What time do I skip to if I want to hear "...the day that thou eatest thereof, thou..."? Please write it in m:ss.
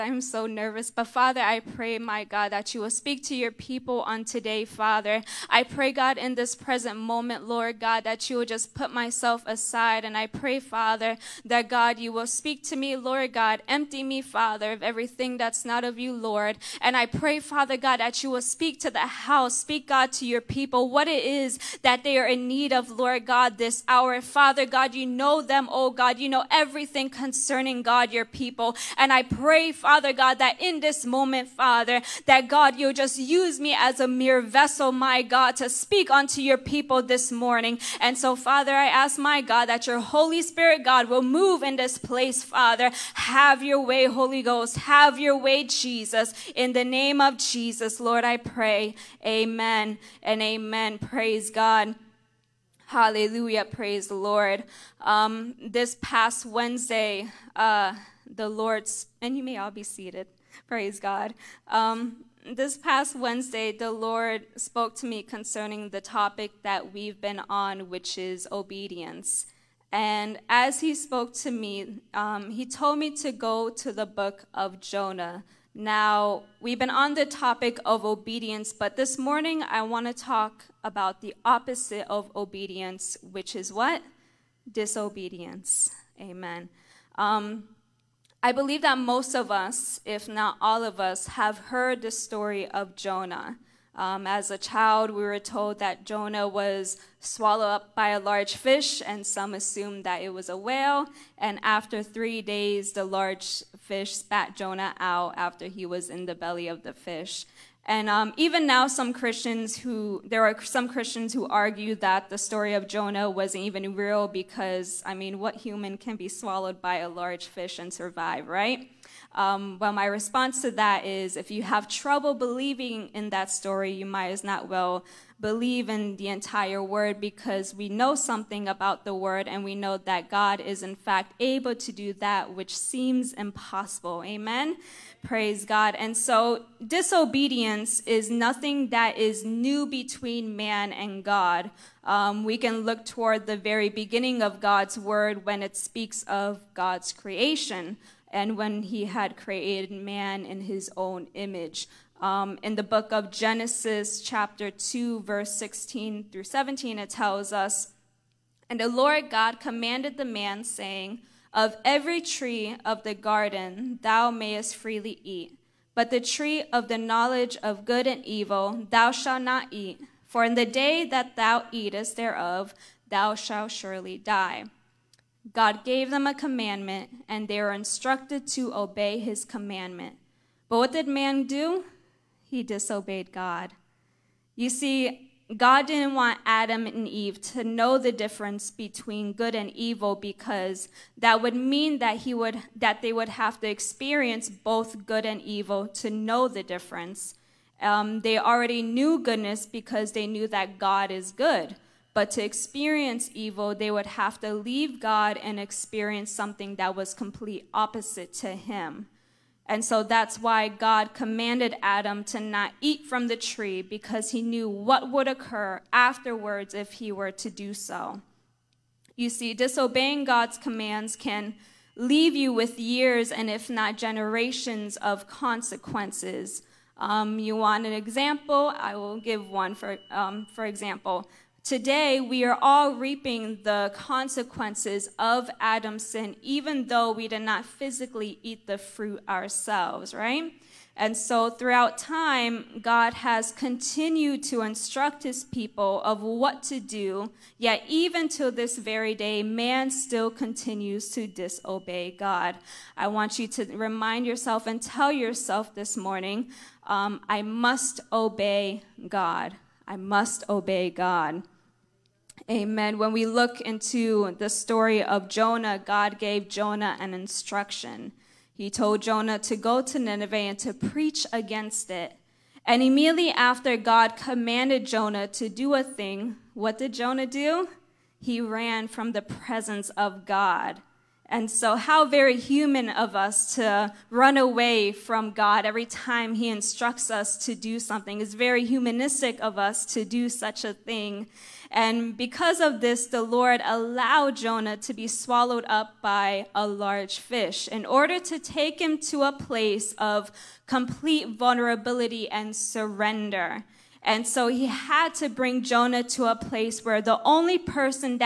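2:50.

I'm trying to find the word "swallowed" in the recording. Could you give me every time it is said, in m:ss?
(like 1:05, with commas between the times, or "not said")
1:37, 1:56, 4:55.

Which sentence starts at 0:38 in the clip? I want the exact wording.
And so, Father, I ask, my God, that your Holy Spirit, God, will move in this place, Father.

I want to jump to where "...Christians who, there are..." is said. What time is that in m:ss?
1:49.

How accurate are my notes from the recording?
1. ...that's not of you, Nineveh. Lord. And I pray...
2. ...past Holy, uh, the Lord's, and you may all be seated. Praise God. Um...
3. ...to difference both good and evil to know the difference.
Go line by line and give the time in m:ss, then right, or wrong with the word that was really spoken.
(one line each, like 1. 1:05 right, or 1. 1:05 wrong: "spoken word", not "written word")
1. 0:15 wrong: "Lord", not "Nineveh"
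2. 0:56 wrong: "Wednesday", not "Holy"
3. 3:13 wrong: "experience", not "difference".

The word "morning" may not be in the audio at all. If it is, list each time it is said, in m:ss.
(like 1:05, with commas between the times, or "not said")
0:37, 1:19, 4:15.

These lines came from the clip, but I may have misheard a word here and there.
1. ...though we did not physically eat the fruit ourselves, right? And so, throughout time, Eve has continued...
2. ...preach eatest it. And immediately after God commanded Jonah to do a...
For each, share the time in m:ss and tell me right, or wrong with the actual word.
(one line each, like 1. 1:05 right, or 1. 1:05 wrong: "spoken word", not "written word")
1. 3:56 wrong: "God", not "Eve"
2. 4:30 wrong: "against", not "eatest".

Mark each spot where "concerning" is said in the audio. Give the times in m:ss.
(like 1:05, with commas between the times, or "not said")
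0:27, 1:05.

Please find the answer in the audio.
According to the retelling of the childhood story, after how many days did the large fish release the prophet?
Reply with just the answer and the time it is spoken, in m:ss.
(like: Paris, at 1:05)
3, at 1:42.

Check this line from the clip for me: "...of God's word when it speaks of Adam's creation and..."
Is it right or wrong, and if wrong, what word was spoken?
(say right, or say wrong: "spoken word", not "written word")
wrong: "God", not "Adam".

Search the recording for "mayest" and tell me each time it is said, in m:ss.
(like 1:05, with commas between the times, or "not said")
2:44.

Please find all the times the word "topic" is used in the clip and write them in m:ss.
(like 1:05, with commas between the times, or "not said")
1:06, 1:17.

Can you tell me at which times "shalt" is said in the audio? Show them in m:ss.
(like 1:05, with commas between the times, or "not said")
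2:49, 2:53.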